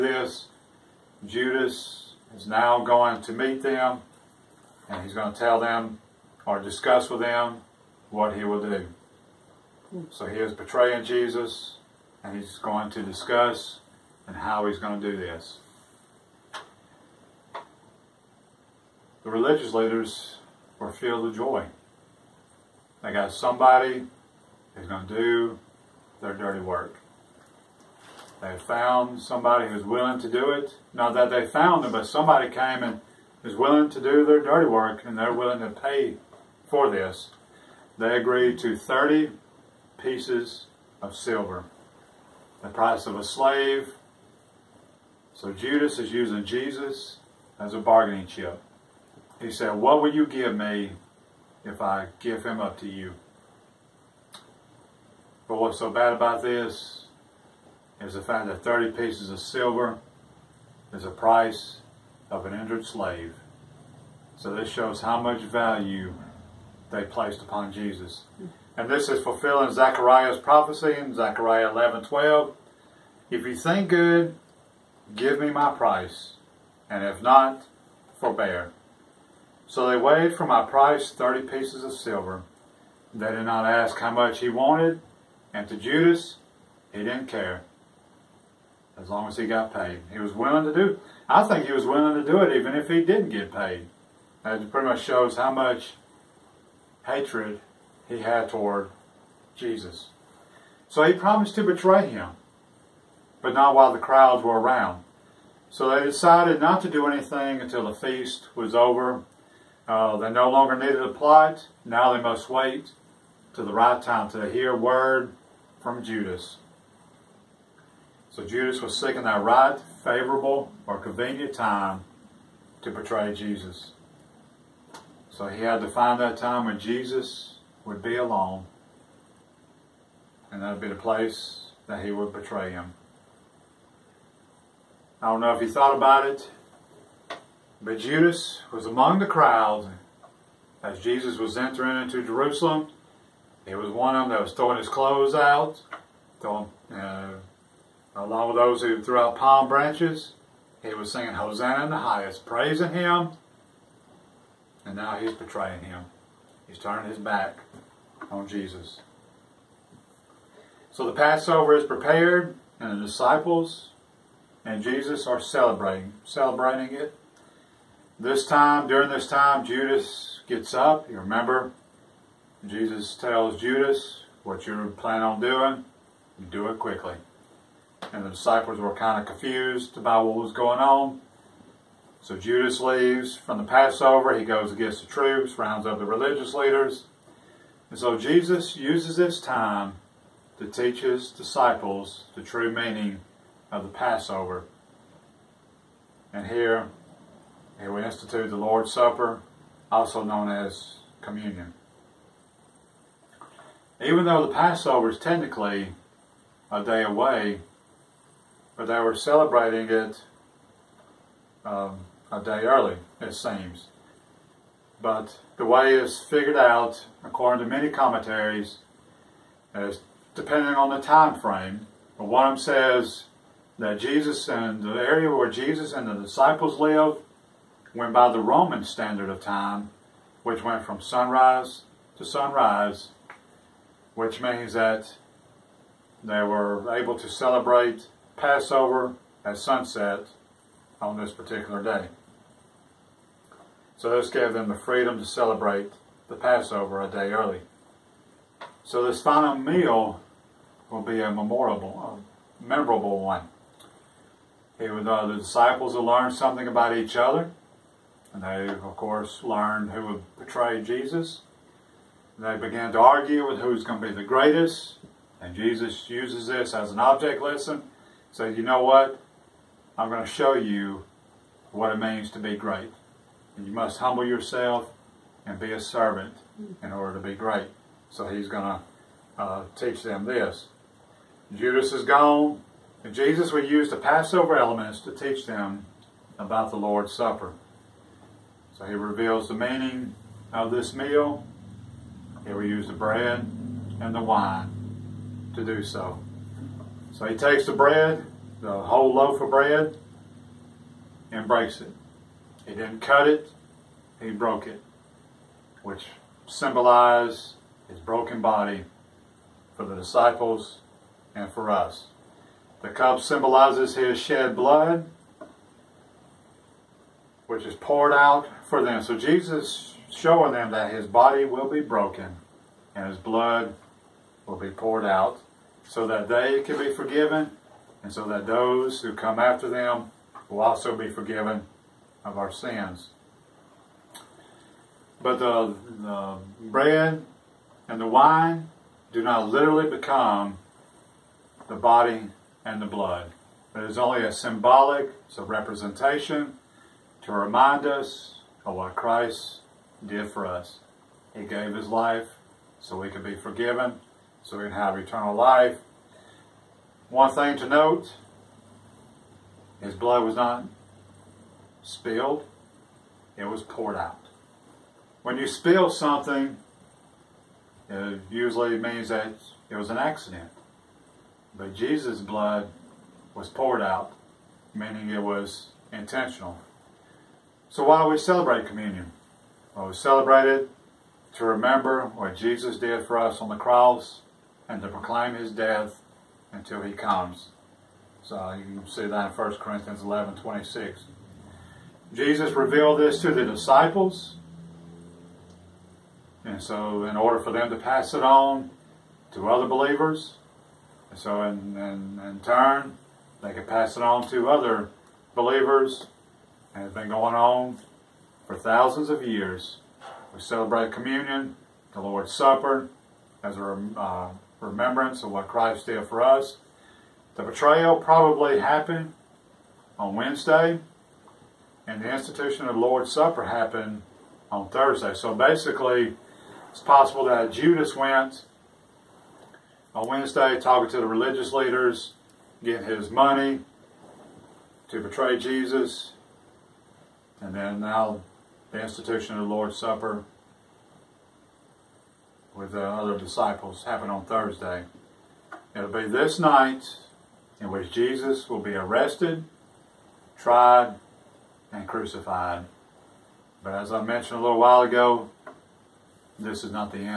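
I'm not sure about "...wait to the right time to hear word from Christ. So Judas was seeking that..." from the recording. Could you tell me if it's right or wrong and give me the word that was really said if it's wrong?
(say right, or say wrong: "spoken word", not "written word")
wrong: "Judas", not "Christ".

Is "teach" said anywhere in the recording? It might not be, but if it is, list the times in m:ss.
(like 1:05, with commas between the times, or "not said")
3:10, 4:39, 4:45.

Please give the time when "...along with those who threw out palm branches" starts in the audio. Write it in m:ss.
2:28.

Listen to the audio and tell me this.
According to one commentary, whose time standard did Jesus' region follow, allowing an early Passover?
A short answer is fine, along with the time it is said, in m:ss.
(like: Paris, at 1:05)
Roman, at 3:48.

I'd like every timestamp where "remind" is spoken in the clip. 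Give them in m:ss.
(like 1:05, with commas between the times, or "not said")
5:47.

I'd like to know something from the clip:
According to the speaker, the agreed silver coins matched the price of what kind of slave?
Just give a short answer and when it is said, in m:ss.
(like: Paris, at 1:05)
An injured slave, at 1:02.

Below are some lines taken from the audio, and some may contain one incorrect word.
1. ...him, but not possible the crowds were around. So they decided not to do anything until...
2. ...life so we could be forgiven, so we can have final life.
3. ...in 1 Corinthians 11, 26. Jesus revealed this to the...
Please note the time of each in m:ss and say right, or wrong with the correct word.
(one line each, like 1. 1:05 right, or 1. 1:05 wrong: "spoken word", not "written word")
1. 1:42 wrong: "while", not "possible"
2. 5:51 wrong: "eternal", not "final"
3. 6:29 right.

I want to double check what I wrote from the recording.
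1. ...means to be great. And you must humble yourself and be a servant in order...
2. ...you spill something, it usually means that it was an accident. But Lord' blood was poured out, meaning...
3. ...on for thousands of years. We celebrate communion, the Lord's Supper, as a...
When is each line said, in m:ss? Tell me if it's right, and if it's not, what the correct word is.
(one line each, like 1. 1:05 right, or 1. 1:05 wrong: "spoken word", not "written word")
1. 4:31 right
2. 6:05 wrong: "Jesus", not "Lord"
3. 6:47 right.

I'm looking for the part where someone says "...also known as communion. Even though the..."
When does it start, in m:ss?
3:19.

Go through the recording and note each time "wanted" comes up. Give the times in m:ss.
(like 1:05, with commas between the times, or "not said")
1:24.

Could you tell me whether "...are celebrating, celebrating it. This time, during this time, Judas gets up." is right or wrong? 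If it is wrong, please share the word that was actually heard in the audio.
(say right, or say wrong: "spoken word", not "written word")
right.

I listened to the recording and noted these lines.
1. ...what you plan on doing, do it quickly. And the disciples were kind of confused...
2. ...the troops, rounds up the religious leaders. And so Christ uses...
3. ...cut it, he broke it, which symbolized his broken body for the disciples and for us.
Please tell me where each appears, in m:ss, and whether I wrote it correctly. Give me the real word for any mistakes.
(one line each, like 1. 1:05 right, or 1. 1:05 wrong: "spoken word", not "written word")
1. 2:54 right
2. 3:05 wrong: "Jesus", not "Christ"
3. 5:03 right.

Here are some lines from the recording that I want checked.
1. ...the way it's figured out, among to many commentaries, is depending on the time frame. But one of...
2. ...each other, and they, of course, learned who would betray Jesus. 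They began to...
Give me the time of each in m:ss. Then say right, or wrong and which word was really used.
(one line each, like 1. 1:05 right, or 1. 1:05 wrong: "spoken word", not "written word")
1. 3:35 wrong: "according", not "among"
2. 4:16 right.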